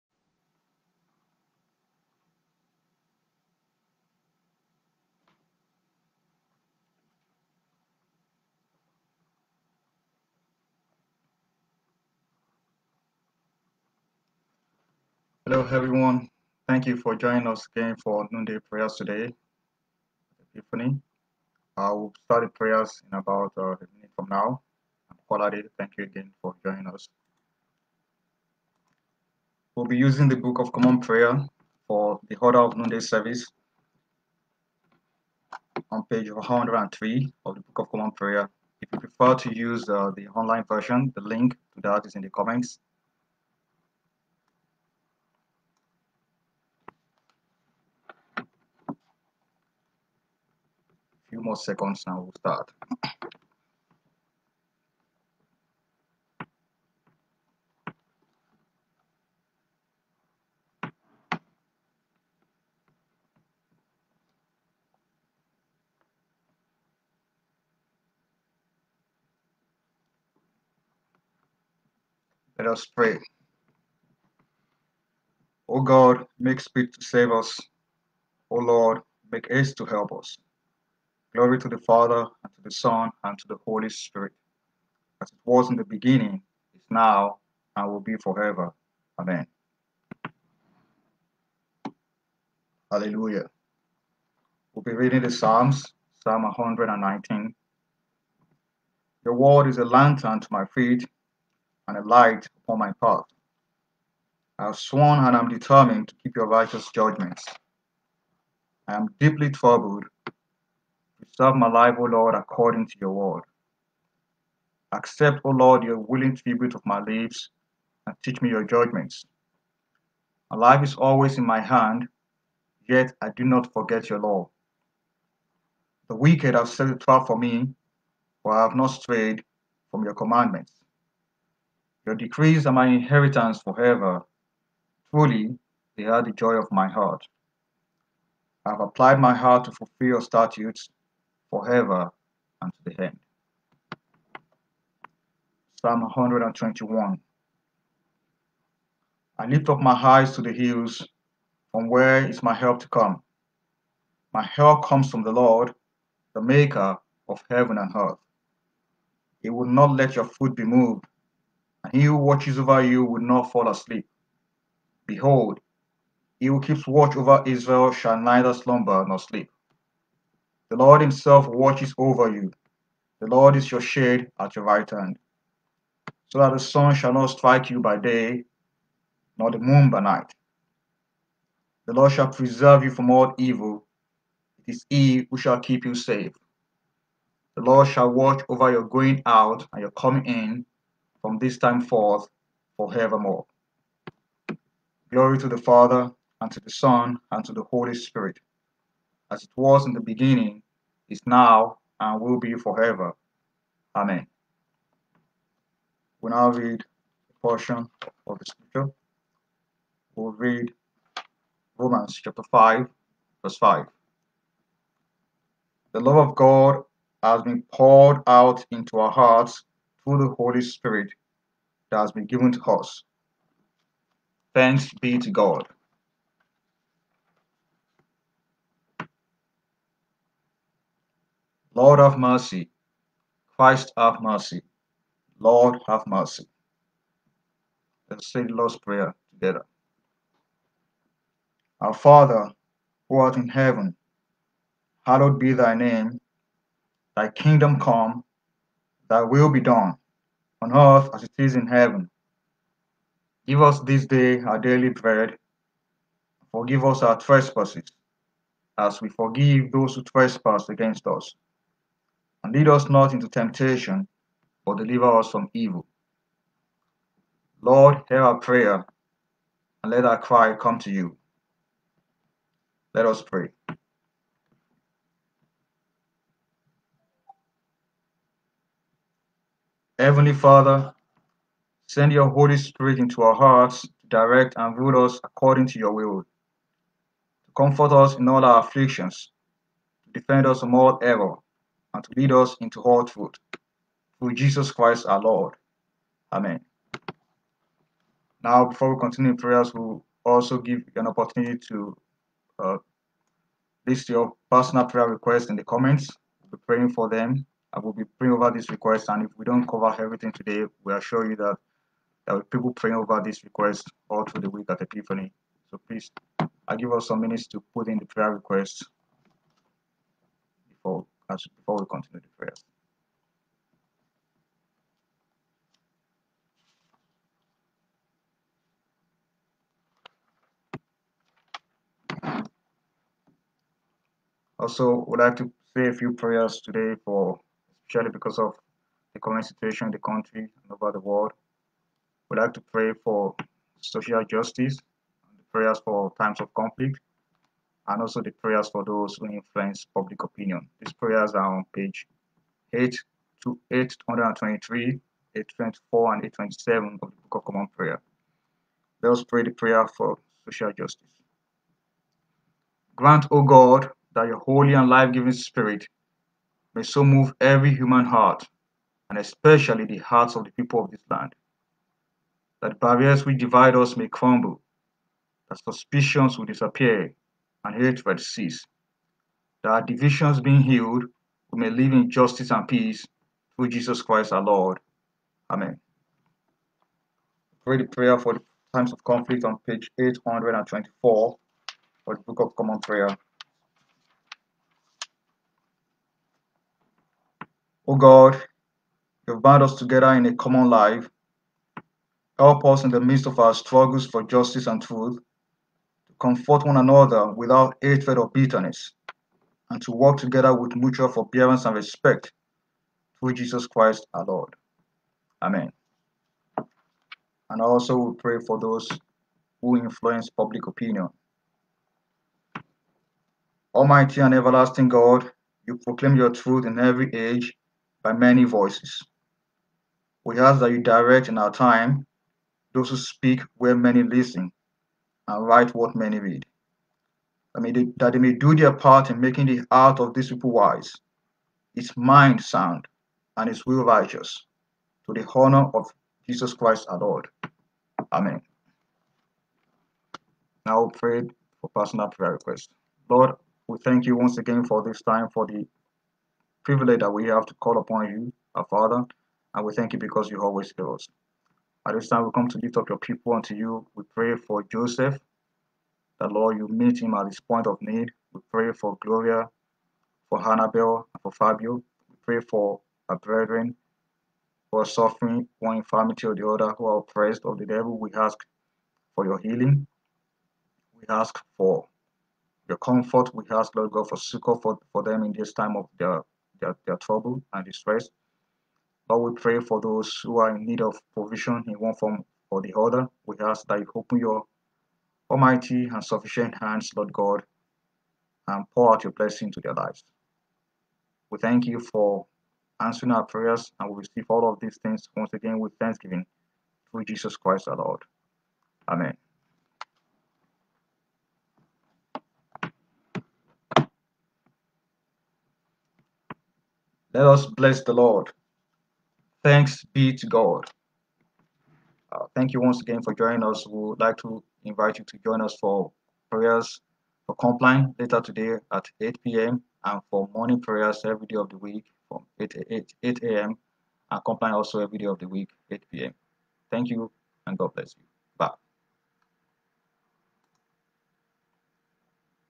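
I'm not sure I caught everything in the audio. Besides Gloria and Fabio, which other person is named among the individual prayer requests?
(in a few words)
Hannabel.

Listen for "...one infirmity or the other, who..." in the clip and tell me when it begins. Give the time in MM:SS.
07:55.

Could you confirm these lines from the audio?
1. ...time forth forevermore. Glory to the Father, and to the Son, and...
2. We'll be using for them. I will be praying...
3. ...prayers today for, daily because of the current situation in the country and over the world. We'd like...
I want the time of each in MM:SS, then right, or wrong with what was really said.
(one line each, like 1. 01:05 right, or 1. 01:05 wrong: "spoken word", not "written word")
1. 03:11 right
2. 05:06 wrong: "praying", not "using"
3. 05:36 wrong: "especially", not "daily".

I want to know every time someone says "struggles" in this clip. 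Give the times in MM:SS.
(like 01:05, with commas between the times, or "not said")
06:43.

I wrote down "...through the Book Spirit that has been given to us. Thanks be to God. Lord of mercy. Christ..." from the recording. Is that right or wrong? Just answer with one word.
wrong.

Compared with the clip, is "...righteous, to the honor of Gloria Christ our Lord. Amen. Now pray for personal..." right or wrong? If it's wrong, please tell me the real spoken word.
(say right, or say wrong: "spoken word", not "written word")
wrong: "Jesus", not "Gloria".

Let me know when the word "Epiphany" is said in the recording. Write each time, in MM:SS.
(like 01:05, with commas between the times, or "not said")
00:20, 05:14.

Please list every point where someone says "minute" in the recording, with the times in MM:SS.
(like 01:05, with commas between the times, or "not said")
00:23, 05:17.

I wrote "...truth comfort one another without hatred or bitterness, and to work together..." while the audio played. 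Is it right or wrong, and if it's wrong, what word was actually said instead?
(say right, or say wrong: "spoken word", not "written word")
right.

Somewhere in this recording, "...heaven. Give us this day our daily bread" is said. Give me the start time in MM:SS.
04:11.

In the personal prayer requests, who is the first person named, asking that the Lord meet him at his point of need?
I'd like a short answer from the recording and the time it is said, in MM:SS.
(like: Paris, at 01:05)
Joseph, at 07:44.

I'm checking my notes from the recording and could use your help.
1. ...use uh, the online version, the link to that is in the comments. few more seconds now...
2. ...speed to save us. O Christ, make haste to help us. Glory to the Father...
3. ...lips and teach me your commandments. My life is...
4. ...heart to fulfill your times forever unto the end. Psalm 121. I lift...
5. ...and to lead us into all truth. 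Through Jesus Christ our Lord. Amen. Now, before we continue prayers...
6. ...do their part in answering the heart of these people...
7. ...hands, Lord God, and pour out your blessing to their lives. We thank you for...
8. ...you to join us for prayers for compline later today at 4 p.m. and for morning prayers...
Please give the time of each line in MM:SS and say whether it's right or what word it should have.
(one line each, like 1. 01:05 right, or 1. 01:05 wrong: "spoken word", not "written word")
1. 00:39 right
2. 01:16 wrong: "Lord", not "Christ"
3. 01:57 wrong: "judgments", not "commandments"
4. 02:19 wrong: "statutes", not "times"
5. 04:51 right
6. 07:18 wrong: "making", not "answering"
7. 08:16 right
8. 08:44 wrong: "8", not "4".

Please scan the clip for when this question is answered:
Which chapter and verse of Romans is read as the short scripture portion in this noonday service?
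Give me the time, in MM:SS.
03:32.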